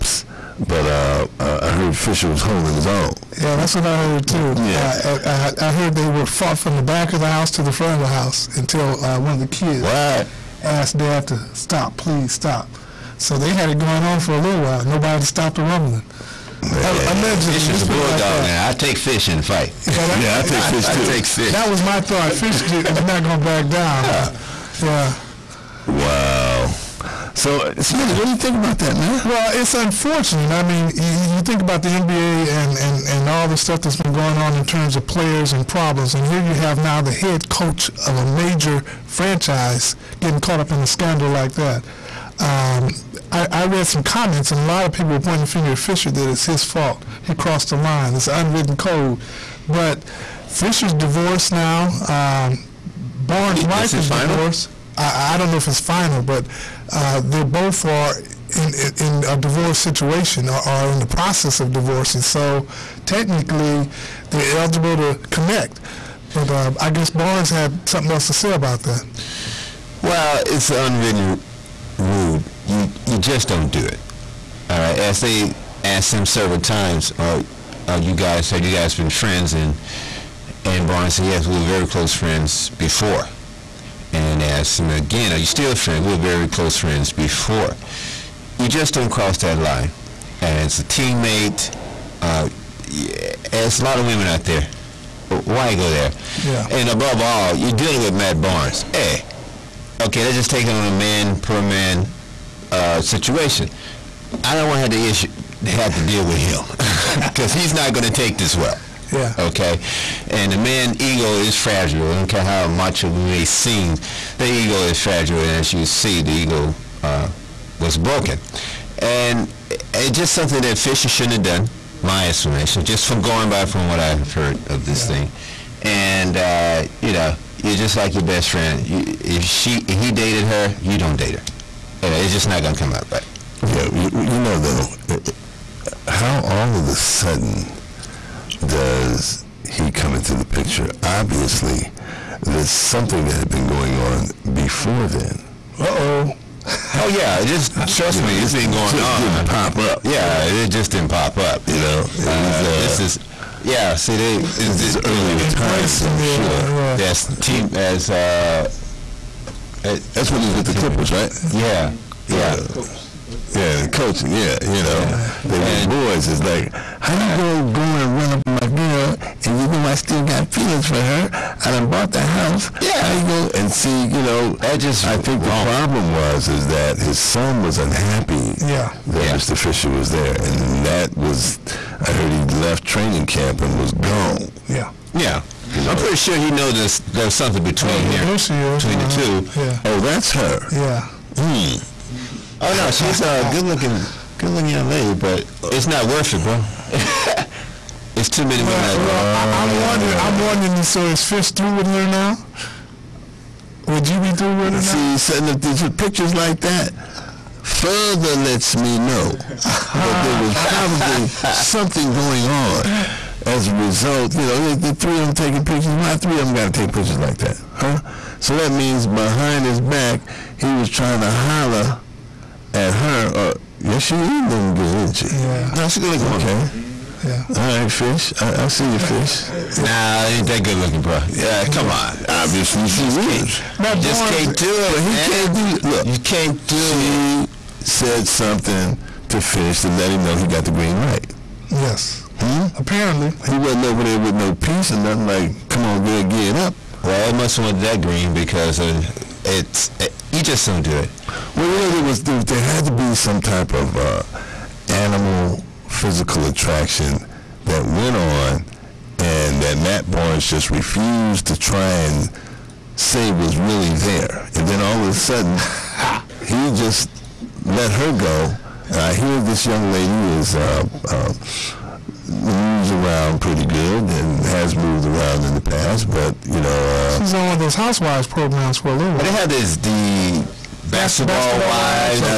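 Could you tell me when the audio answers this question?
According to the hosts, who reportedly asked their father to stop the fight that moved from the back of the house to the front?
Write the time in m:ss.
0:09.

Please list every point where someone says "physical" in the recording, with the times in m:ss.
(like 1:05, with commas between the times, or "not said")
4:15.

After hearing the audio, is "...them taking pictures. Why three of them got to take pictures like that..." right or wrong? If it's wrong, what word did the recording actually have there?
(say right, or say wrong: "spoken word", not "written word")
right.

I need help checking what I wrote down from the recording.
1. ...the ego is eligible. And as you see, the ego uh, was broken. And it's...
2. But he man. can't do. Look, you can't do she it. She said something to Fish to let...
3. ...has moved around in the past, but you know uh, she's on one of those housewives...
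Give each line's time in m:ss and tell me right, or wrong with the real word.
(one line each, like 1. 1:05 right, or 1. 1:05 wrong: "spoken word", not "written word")
1. 1:54 wrong: "fragile", not "eligible"
2. 3:54 right
3. 4:34 right.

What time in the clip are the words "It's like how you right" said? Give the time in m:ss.
2:46.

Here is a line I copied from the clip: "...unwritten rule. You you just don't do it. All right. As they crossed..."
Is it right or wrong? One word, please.
wrong.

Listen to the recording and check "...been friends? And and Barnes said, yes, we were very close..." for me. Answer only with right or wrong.
right.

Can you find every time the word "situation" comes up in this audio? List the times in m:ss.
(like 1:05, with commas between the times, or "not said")
0:59, 1:43.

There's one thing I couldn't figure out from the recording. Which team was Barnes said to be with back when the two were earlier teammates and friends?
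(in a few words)
Clippers.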